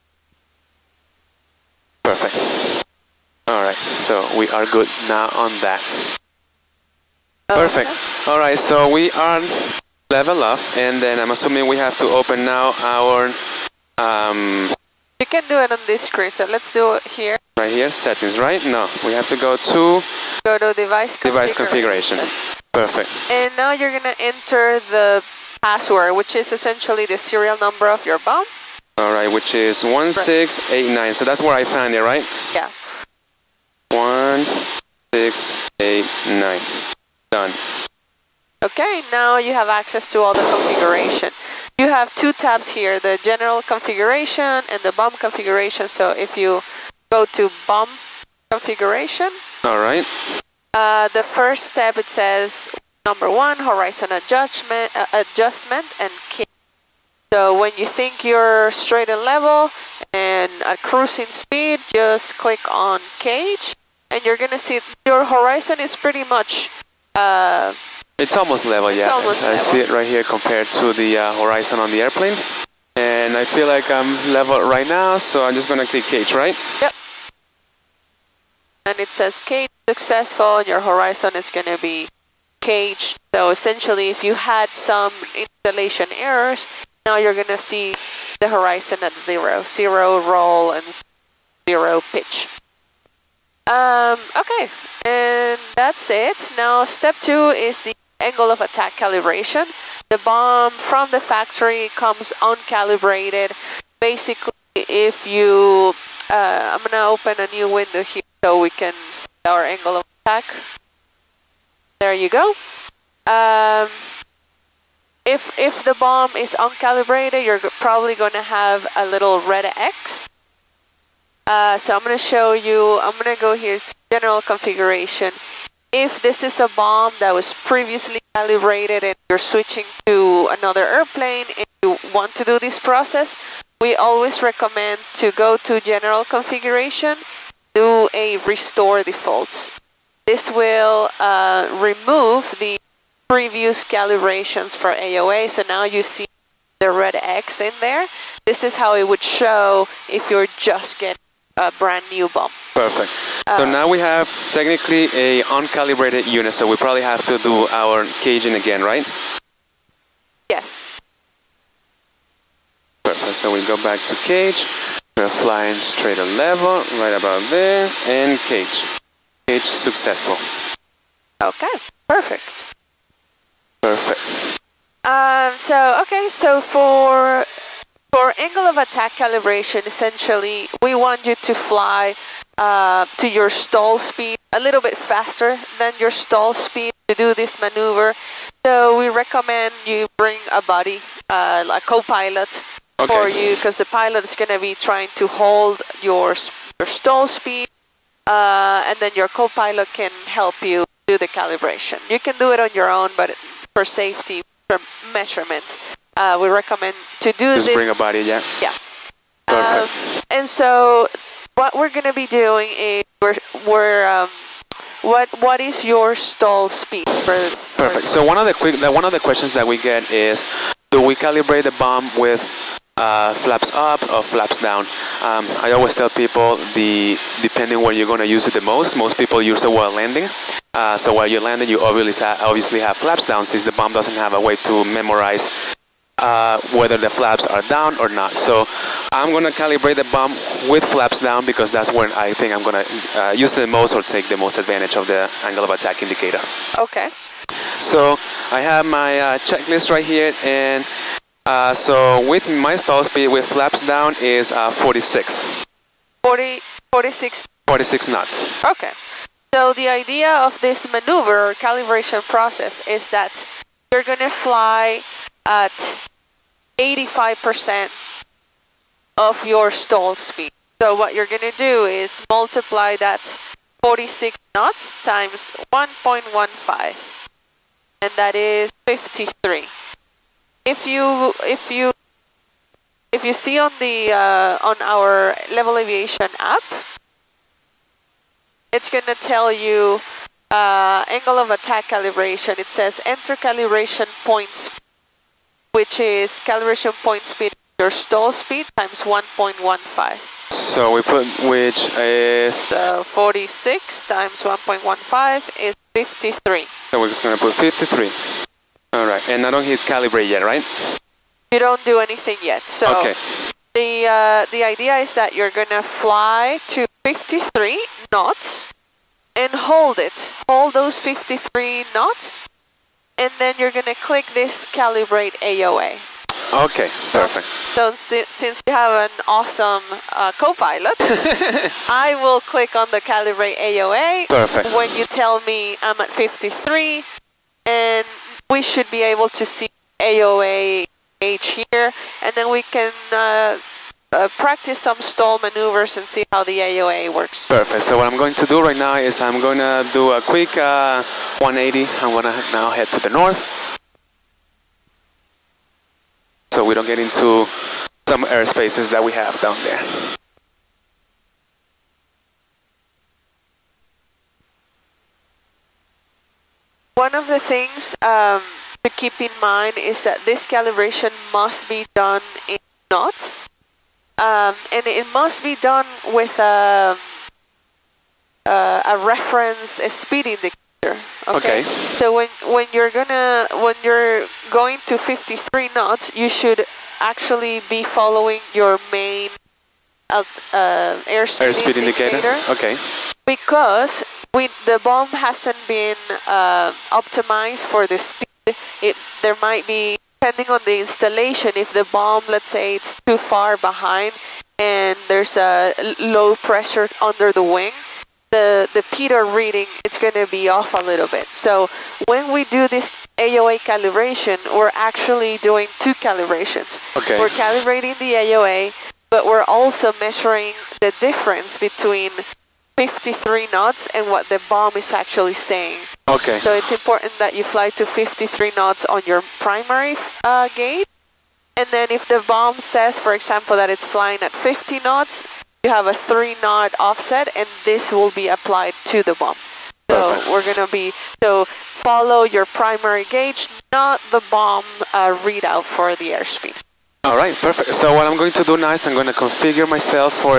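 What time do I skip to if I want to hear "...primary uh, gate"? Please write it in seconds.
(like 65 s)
429 s.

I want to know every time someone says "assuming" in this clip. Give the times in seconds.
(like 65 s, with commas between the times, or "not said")
11 s.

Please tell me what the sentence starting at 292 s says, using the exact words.
It says enter calibration points which is calibration point speed, your stall speed times 1.15.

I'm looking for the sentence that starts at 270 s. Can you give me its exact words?
So what you're going to do is multiply that 46 knots times 1.15 and that is 53.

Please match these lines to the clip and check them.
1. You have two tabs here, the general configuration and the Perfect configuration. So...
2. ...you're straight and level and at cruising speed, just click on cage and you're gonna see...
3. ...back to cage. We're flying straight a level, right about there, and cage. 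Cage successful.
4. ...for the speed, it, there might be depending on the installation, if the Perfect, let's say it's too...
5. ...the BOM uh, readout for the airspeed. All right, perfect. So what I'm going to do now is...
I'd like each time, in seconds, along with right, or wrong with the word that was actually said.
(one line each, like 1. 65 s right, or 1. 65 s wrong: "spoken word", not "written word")
1. 41 s wrong: "BOM", not "Perfect"
2. 58 s right
3. 163 s right
4. 397 s wrong: "BOM", not "Perfect"
5. 444 s right.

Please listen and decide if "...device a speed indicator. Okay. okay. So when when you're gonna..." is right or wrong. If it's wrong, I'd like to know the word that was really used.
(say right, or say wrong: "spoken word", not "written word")
wrong: "reference", not "device".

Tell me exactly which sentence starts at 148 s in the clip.
This is how it would show if you're just getting a brand new BOM.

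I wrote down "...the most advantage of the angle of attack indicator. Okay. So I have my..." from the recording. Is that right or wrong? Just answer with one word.
right.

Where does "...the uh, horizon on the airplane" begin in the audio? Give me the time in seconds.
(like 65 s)
70 s.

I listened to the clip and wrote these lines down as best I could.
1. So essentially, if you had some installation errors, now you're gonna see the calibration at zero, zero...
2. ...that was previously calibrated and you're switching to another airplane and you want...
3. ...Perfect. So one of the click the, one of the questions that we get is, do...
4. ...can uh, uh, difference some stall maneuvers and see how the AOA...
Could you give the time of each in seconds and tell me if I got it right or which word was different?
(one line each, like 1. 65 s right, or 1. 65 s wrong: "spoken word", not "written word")
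1. 83 s wrong: "horizon", not "calibration"
2. 127 s right
3. 217 s wrong: "quick", not "click"
4. 342 s wrong: "practice", not "difference".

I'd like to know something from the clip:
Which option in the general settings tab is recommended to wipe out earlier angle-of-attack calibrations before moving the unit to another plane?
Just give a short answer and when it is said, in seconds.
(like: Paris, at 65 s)
restore defaults, at 138 s.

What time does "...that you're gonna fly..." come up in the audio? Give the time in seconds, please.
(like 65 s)
263 s.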